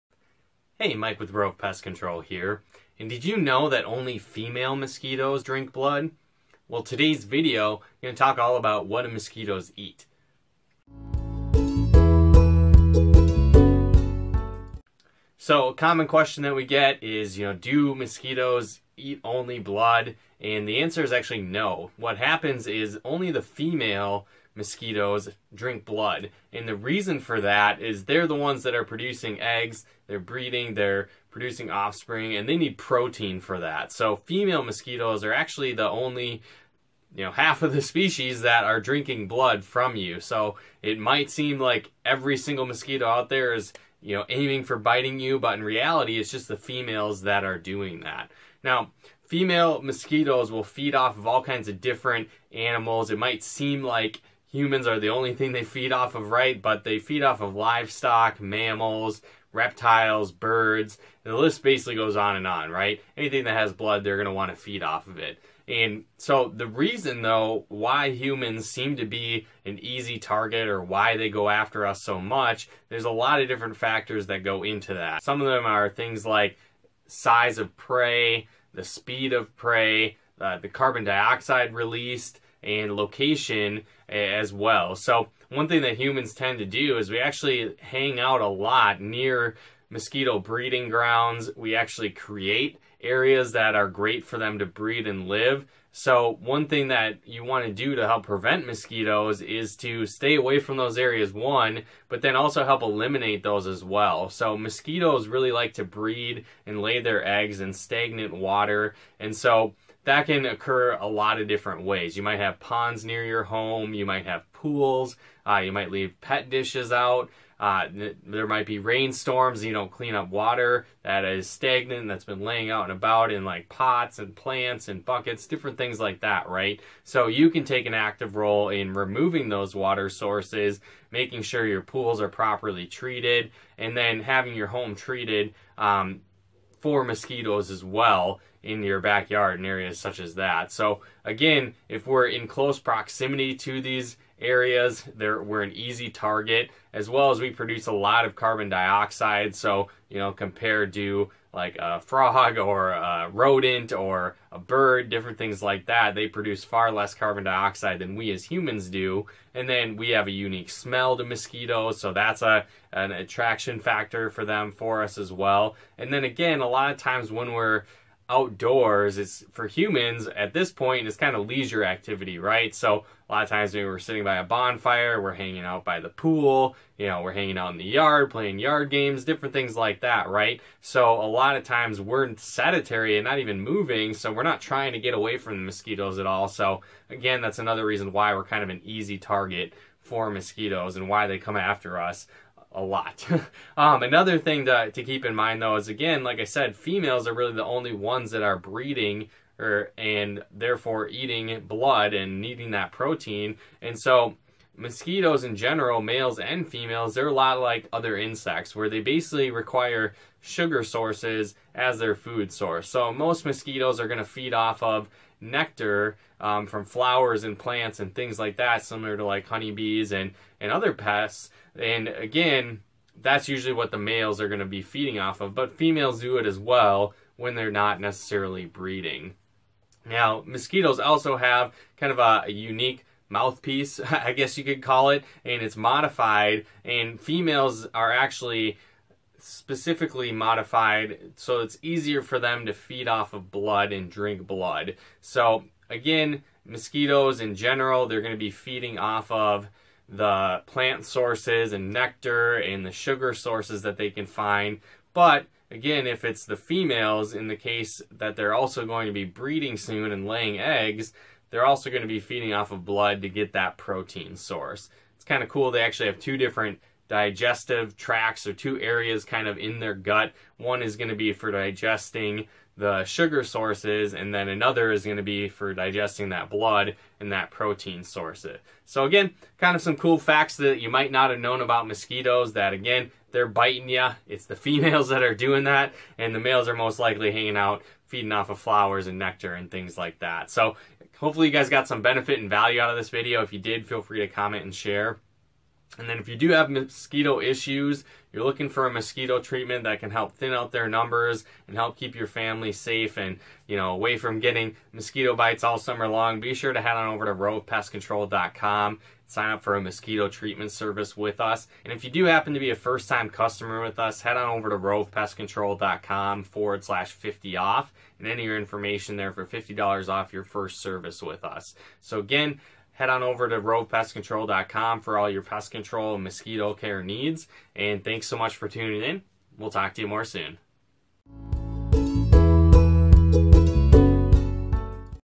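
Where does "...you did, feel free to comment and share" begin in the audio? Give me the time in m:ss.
4:53.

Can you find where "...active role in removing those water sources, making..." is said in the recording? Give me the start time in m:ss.
2:07.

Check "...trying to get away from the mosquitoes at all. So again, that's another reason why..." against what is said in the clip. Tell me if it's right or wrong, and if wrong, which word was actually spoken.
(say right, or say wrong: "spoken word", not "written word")
right.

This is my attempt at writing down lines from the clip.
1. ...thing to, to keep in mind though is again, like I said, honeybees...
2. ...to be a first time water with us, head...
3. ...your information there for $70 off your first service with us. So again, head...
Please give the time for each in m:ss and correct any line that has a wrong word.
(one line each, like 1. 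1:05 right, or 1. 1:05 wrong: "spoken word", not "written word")
1. 3:14 wrong: "females", not "honeybees"
2. 5:12 wrong: "customer", not "water"
3. 5:18 wrong: "50", not "70".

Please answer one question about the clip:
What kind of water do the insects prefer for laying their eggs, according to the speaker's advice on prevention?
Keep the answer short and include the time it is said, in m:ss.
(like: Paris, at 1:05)
stagnant water, at 1:47.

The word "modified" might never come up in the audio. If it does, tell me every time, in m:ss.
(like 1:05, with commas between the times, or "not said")
3:55, 4:00.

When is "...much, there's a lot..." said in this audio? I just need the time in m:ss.
1:12.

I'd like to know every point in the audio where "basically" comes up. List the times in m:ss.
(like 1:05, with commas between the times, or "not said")
1:01, 3:29.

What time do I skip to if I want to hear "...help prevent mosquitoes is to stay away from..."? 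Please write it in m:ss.
1:38.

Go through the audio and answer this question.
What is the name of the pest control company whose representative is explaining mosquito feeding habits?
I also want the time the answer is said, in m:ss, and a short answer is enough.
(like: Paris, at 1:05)
Rove Pest Control, at 0:01.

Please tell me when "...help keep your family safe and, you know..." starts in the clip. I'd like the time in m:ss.
5:01.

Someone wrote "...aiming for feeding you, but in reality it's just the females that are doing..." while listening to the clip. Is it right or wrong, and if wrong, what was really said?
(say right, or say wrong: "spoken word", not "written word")
wrong: "biting", not "feeding".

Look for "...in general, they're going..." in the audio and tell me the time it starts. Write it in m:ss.
4:07.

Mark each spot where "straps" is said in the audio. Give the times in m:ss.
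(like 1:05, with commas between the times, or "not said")
not said.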